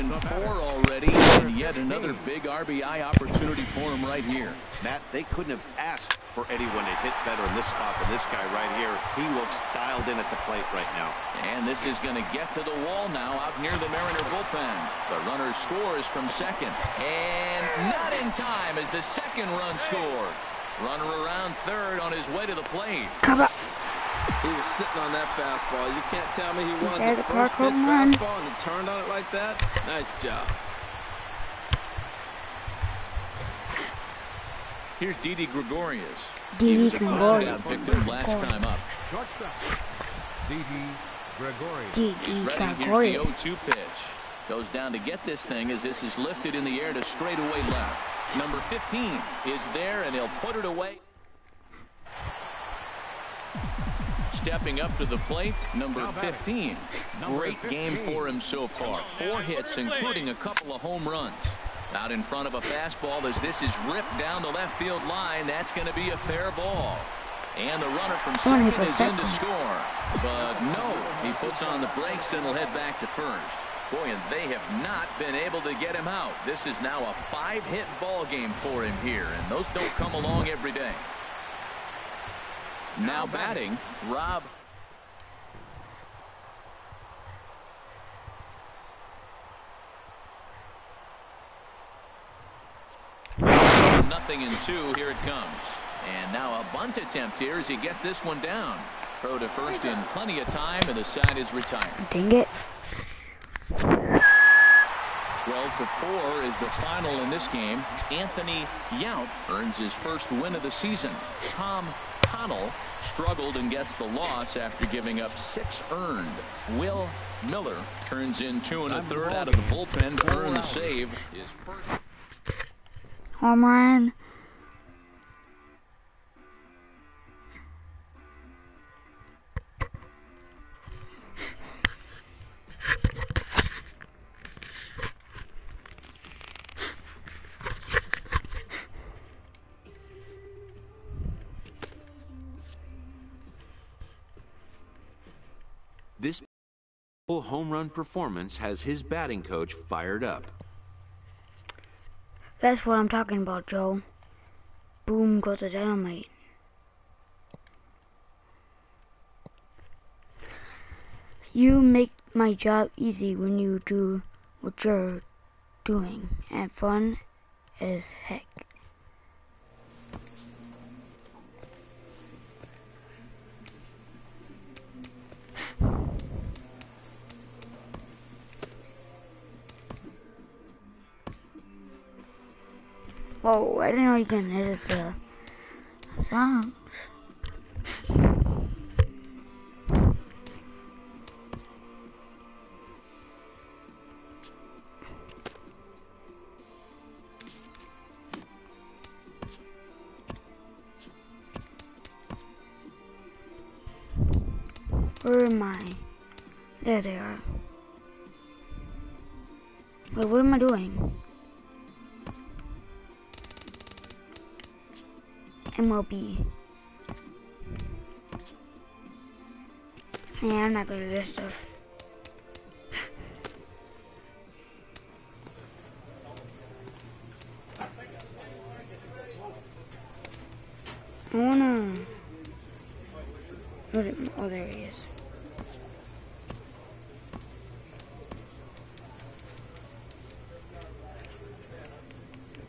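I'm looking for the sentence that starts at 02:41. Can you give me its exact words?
You make my job easy when you do what you're doing, and fun as heck.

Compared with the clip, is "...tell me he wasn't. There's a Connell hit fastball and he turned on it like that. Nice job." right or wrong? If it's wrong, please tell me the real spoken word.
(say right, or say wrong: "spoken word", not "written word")
wrong: "First", not "Connell".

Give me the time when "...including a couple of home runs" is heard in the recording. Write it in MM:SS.
00:59.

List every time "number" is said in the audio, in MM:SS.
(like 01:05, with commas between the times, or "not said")
00:48, 00:55.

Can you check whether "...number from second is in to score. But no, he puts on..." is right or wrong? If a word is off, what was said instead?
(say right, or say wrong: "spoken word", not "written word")
wrong: "runner", not "number".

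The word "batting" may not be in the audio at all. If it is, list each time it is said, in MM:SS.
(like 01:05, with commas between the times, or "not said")
01:23, 02:29.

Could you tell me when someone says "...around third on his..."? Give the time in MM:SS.
00:21.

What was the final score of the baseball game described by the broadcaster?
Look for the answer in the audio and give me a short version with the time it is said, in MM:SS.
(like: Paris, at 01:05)
12 to 4, at 01:43.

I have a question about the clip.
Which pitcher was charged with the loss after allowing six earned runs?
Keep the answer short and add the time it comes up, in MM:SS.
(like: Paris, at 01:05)
Tom Connell, at 01:51.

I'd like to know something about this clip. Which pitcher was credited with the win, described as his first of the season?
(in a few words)
Anthony Yount.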